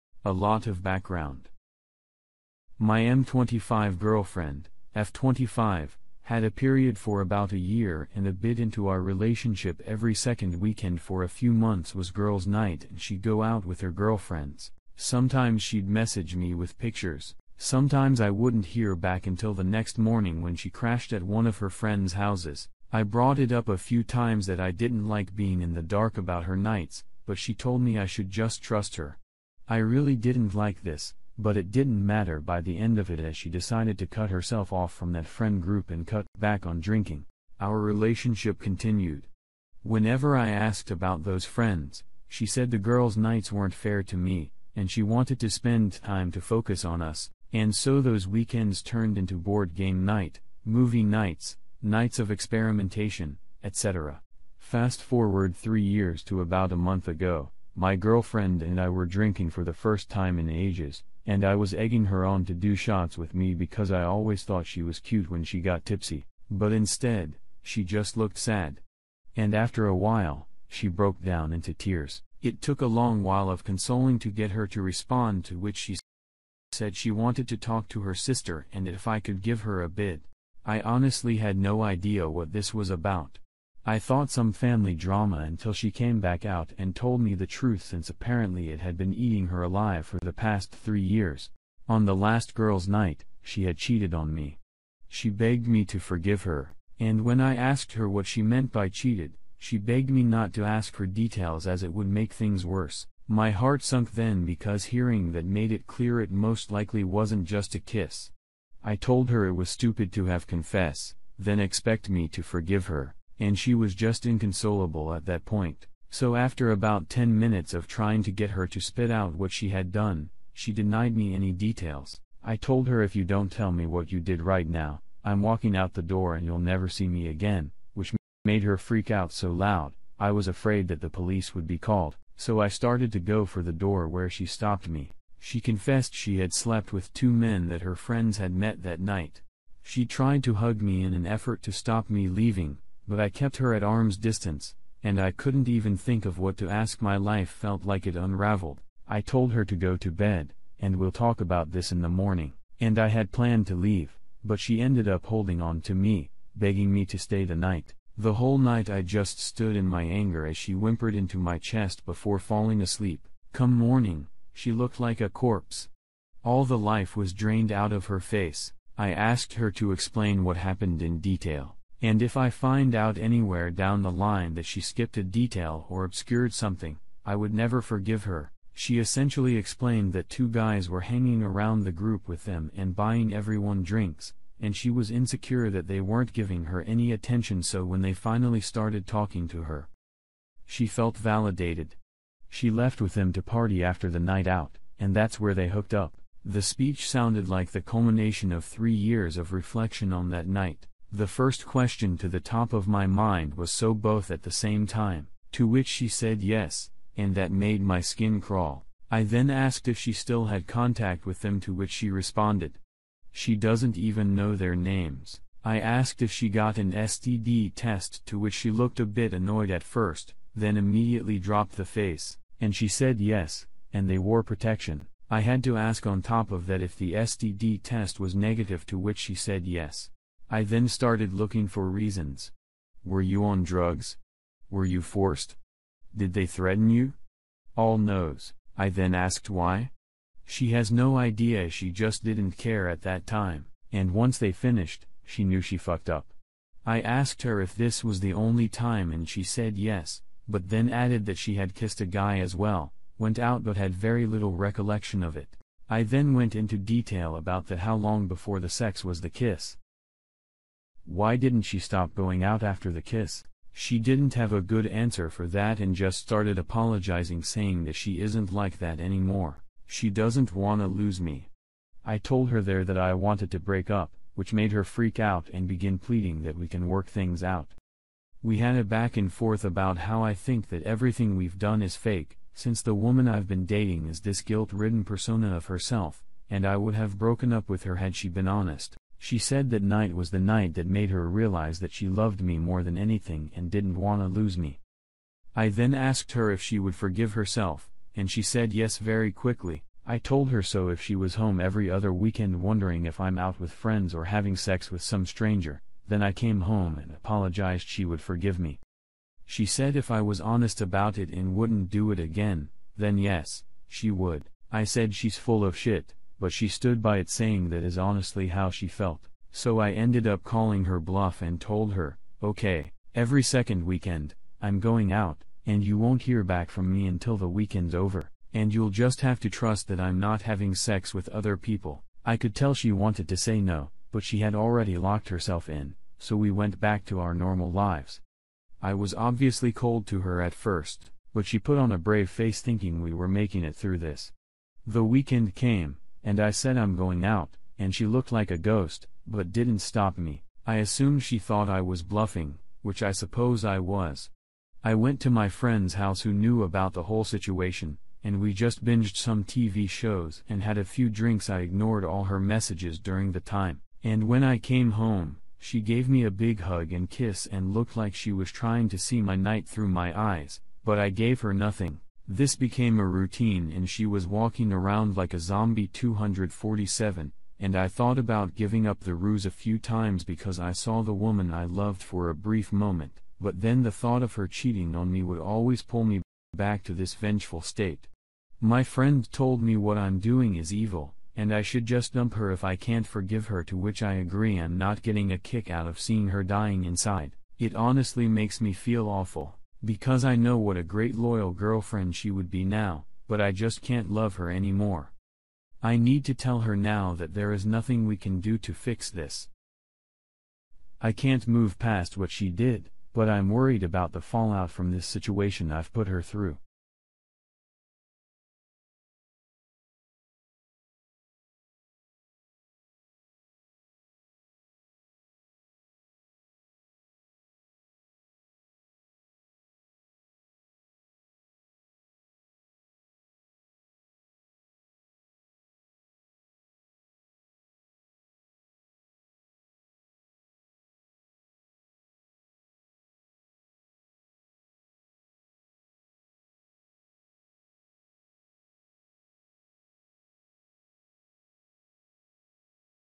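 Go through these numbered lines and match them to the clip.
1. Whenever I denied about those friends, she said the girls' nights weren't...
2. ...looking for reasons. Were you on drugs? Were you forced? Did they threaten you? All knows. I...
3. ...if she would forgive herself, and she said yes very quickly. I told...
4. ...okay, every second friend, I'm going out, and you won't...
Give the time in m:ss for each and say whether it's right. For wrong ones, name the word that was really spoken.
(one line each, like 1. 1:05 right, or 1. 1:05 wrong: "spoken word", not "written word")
1. 0:39 wrong: "asked", not "denied"
2. 3:51 right
3. 4:56 right
4. 5:22 wrong: "weekend", not "friend".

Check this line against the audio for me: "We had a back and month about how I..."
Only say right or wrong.
wrong.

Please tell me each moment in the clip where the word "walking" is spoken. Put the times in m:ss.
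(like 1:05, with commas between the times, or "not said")
2:05, 6:14.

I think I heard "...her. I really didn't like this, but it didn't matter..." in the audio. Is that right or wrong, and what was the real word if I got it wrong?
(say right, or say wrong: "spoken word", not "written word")
right.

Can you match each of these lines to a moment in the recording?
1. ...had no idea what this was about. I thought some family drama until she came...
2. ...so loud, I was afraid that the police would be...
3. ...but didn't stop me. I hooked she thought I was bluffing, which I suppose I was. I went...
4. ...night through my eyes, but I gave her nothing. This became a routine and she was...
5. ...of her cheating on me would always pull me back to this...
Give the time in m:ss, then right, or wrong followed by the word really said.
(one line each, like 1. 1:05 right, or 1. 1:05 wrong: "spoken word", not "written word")
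1. 1:21 right
2. 2:09 right
3. 5:49 wrong: "assumed", not "hooked"
4. 6:09 right
5. 6:24 right.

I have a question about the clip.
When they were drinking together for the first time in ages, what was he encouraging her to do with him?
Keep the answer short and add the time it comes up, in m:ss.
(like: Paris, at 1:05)
shots, at 1:02.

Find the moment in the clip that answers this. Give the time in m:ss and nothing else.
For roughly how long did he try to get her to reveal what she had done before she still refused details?
1:57.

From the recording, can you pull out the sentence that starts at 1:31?
On the last girl's night, she had cheated on me.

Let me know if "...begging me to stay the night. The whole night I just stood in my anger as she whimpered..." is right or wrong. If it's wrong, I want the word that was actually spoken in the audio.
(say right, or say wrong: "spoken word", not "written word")
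right.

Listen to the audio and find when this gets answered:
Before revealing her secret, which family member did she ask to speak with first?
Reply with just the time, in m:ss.
1:18.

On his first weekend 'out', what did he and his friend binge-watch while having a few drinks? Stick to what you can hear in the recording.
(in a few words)
TV shows.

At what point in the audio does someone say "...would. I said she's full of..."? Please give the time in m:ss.
5:14.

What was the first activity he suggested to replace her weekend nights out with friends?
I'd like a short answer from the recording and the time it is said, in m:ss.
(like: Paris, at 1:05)
board game night, at 0:49.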